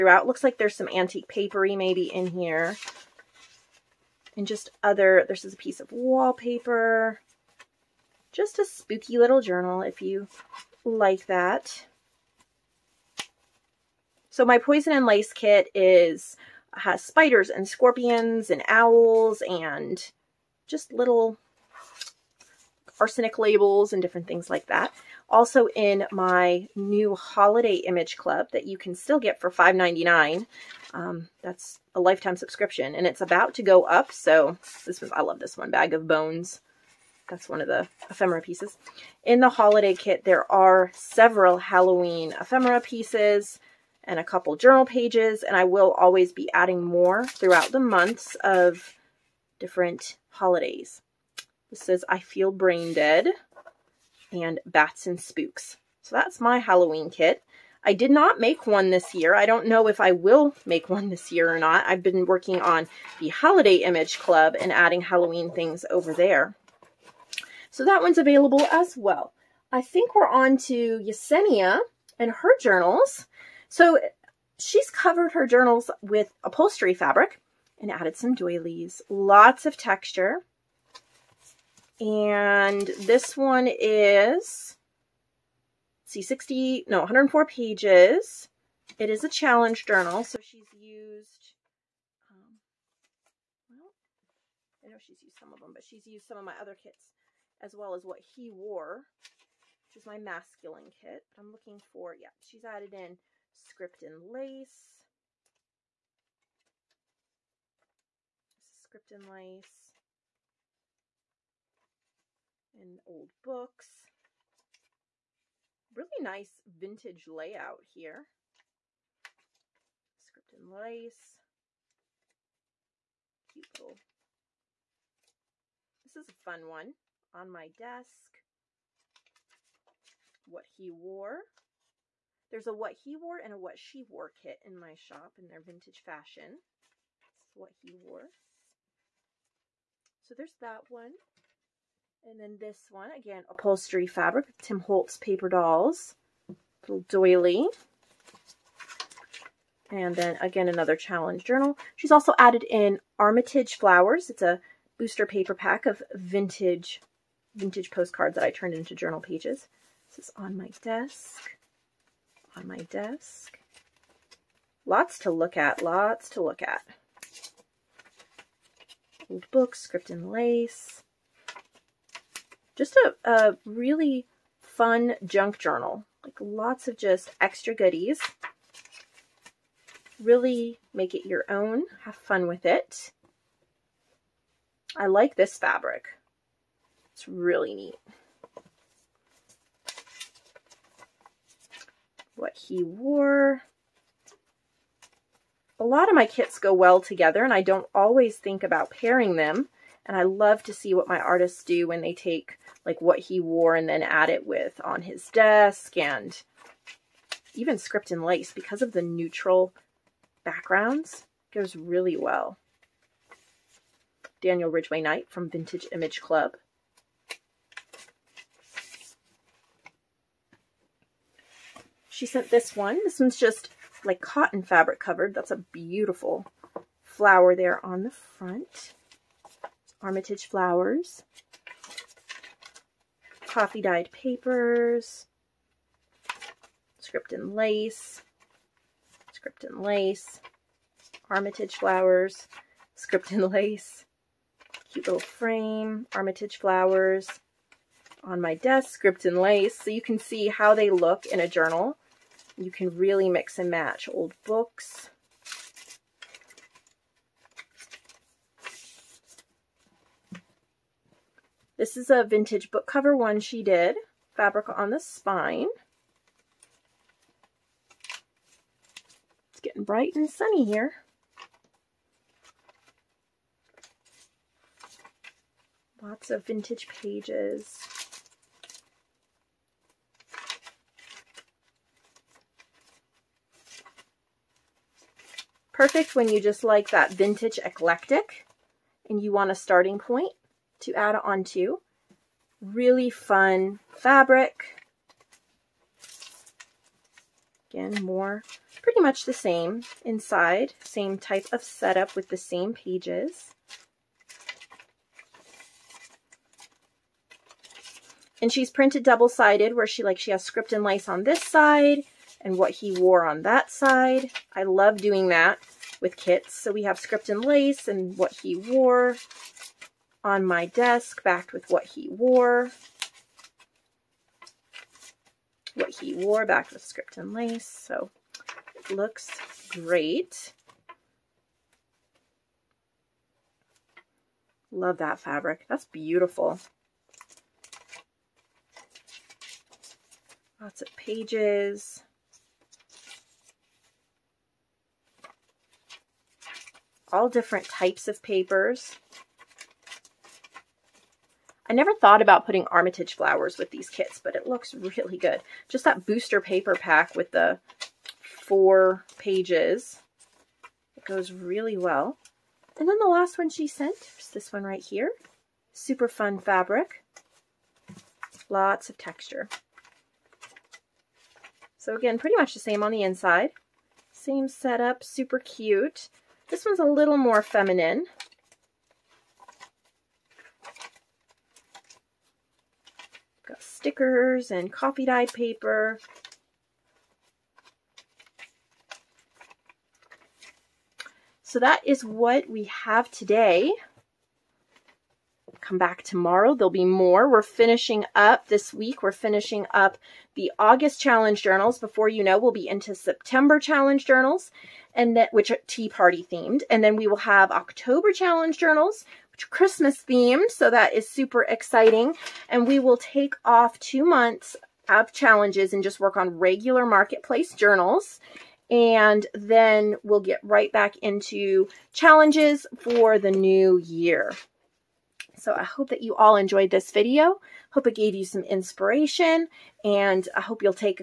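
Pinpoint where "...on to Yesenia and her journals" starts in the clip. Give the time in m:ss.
1:10.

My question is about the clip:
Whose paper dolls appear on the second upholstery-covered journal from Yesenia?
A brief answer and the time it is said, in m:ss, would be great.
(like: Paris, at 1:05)
Tim Holtz, at 2:24.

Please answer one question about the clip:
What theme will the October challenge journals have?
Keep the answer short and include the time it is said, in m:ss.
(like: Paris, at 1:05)
Christmas, at 6:49.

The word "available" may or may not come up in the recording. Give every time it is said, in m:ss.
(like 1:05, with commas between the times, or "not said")
1:08.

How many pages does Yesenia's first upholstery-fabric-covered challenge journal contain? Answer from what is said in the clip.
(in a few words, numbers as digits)
104.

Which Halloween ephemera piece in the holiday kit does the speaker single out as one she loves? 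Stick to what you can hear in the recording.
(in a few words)
Bag of Bones.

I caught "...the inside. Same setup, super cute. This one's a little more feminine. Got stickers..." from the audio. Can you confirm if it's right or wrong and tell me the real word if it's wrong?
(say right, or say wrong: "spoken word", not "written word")
right.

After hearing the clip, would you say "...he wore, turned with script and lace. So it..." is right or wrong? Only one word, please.
wrong.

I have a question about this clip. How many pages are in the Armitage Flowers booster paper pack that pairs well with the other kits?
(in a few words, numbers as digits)
4.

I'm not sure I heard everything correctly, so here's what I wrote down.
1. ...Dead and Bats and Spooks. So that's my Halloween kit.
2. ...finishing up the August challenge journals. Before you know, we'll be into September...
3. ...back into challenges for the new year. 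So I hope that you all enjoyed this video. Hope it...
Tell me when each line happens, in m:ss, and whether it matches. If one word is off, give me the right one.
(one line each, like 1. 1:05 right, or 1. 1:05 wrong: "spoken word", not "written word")
1. 0:52 right
2. 6:39 right
3. 7:00 right.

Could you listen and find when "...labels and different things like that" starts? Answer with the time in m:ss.
0:23.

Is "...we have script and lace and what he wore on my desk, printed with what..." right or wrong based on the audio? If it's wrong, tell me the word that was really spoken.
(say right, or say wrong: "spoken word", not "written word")
wrong: "backed", not "printed".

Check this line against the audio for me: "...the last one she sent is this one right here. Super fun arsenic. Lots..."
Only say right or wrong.
wrong.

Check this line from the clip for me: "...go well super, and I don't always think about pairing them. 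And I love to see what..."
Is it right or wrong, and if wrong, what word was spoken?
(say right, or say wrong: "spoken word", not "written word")
wrong: "together", not "super".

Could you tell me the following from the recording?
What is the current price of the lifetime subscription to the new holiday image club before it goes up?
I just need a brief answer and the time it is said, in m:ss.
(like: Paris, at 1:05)
$5.99, at 0:29.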